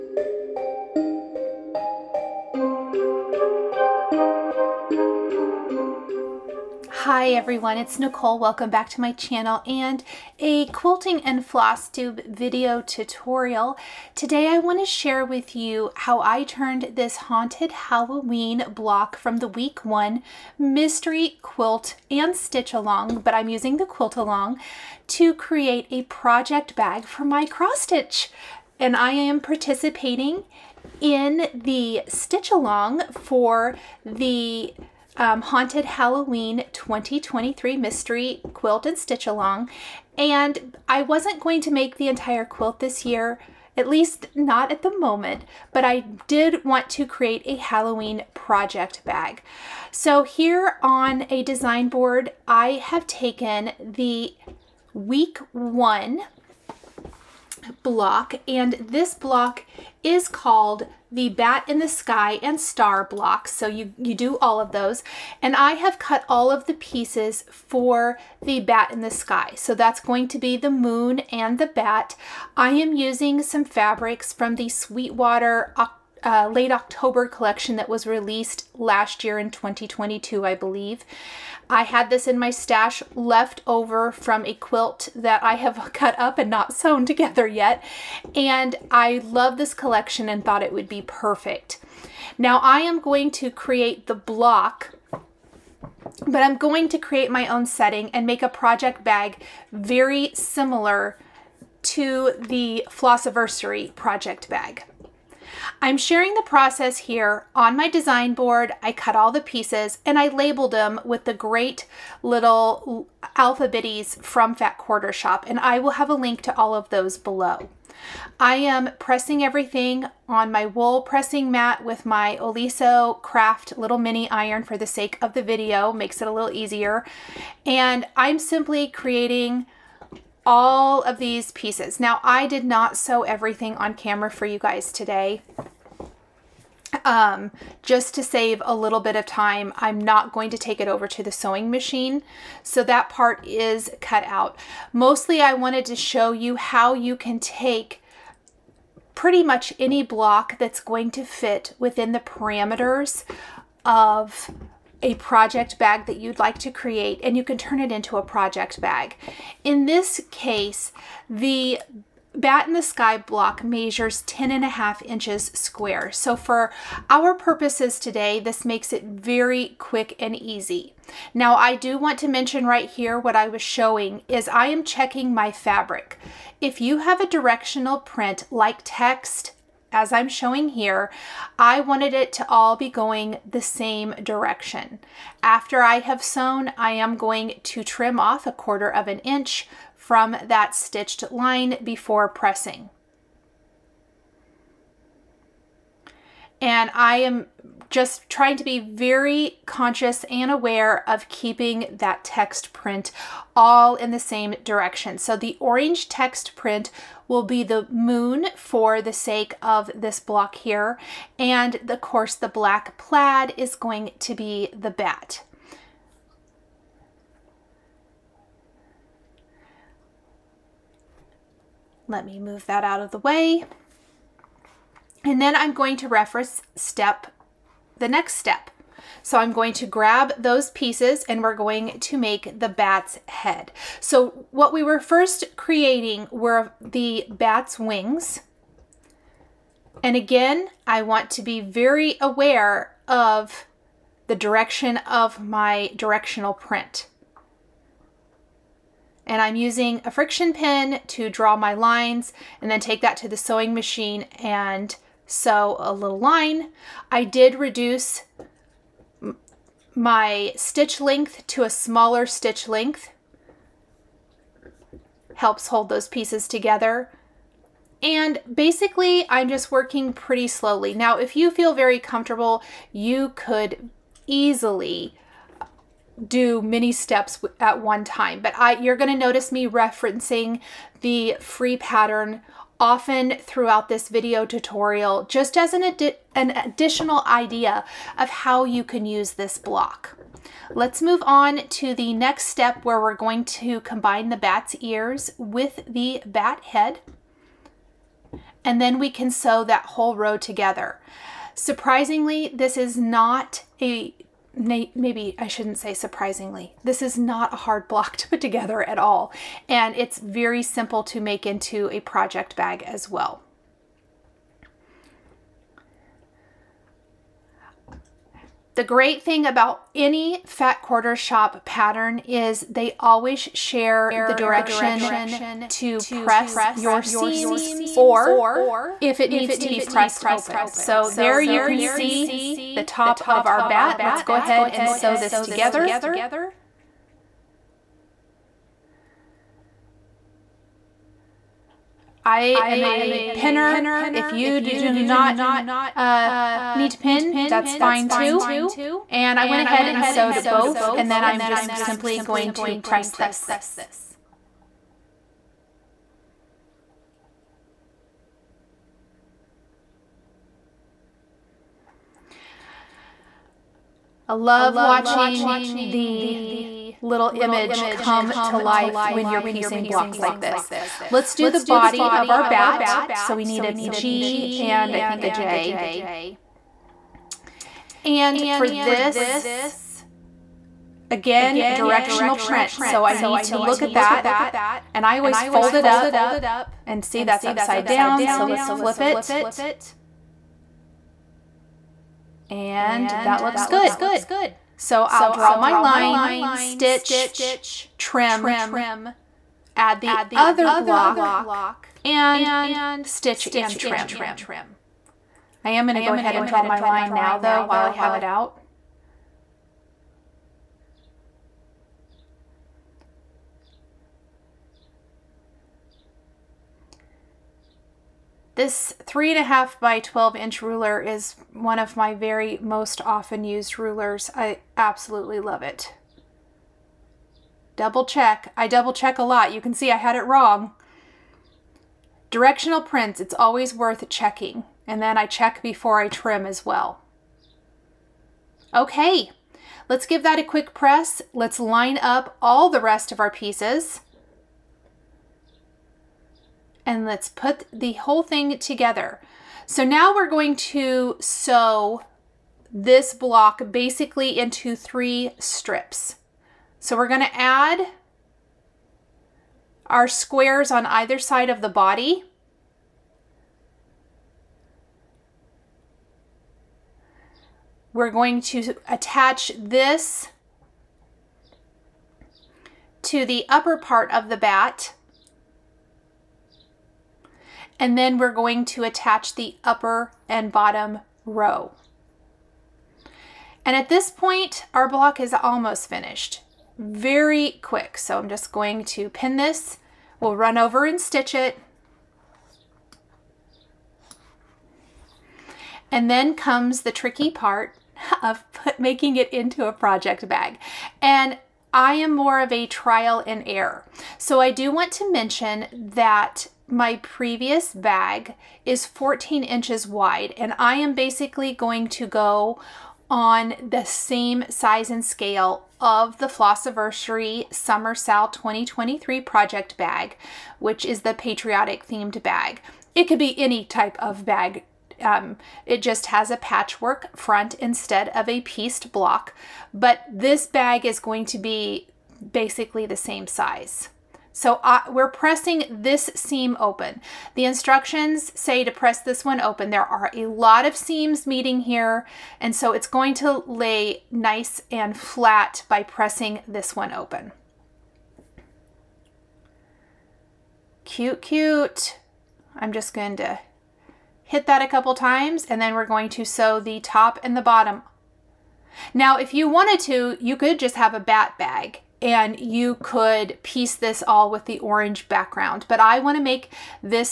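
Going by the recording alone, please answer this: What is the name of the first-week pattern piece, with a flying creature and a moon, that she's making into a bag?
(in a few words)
Bat in the Sky and Star.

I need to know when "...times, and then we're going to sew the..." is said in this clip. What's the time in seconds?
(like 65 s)
554 s.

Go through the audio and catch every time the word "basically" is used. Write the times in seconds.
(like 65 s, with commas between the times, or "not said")
268 s, 453 s, 510 s, 532 s.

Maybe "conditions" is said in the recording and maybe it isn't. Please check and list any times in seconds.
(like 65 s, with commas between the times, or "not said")
not said.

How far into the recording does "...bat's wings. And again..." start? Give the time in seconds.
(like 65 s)
237 s.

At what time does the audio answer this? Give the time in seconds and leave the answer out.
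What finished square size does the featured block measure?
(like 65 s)
164 s.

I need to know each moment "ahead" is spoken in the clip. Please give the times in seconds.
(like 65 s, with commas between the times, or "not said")
334 s, 349 s, 406 s.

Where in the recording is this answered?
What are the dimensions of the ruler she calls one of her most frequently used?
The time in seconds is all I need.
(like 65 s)
419 s.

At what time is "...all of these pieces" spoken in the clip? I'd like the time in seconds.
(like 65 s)
130 s.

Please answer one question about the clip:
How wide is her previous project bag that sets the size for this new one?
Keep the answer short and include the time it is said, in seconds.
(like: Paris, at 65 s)
14 inches, at 508 s.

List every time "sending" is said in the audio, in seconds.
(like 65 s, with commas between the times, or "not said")
not said.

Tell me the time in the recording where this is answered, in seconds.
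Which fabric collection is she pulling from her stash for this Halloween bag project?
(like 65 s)
74 s.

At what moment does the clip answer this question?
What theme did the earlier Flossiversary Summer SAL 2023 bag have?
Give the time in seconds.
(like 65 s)
521 s.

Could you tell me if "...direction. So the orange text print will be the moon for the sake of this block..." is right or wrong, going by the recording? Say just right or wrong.
right.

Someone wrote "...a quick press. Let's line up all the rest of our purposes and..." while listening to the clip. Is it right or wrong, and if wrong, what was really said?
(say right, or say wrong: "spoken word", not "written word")
wrong: "pieces", not "purposes".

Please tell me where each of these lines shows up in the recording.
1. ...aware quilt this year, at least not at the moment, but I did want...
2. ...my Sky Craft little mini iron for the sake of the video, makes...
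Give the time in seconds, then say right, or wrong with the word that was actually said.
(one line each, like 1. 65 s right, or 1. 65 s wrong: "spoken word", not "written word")
1. 42 s wrong: "entire", not "aware"
2. 122 s wrong: "Oliso", not "Sky".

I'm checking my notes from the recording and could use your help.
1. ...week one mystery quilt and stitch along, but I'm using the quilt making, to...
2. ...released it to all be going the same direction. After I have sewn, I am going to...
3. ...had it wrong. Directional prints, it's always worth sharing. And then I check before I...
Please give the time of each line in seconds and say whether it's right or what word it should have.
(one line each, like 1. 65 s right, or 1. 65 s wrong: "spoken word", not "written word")
1. 19 s wrong: "along", not "making"
2. 181 s wrong: "wanted", not "released"
3. 429 s wrong: "checking", not "sharing".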